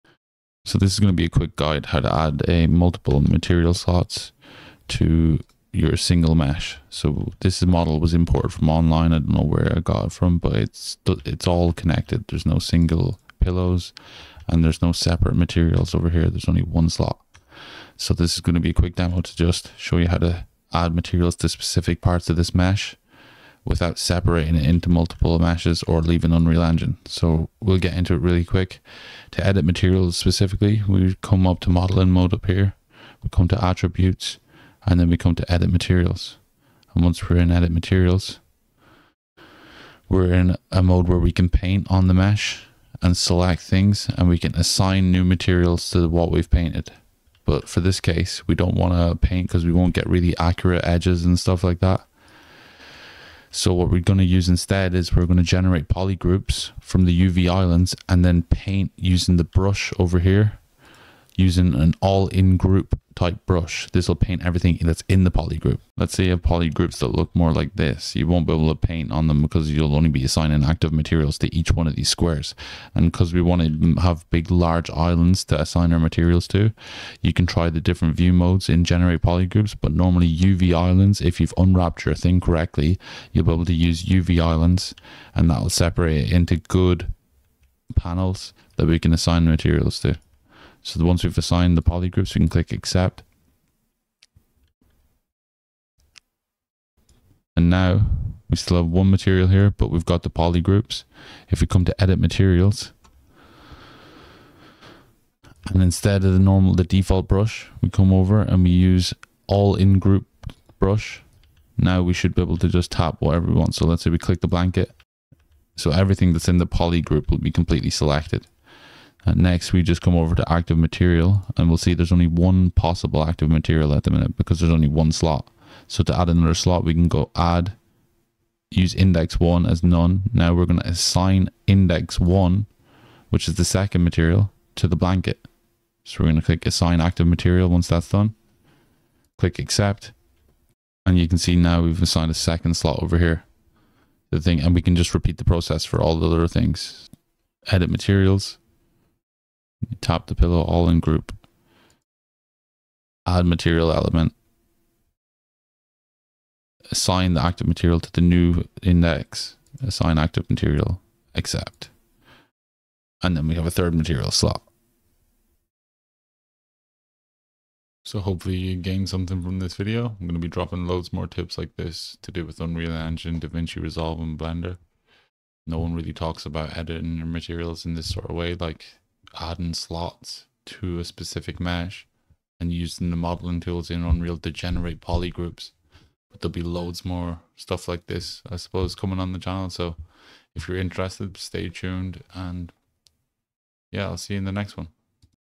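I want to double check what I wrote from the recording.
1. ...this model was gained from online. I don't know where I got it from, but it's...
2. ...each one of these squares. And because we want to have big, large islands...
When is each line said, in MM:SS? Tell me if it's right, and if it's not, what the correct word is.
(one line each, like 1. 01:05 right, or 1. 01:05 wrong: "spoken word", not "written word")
1. 00:07 wrong: "imported", not "gained"
2. 01:11 right.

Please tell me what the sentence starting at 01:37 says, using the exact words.
And now we still have one material here, but we've got the poly groups.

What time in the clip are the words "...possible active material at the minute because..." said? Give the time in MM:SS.
02:02.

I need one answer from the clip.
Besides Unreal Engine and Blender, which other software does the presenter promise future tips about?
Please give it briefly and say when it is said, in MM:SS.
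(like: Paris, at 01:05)
DaVinci Resolve, at 02:53.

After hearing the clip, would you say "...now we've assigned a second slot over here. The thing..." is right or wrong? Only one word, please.
right.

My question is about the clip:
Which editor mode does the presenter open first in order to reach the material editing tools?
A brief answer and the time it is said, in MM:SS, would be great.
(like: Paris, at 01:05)
Modeling mode, at 00:31.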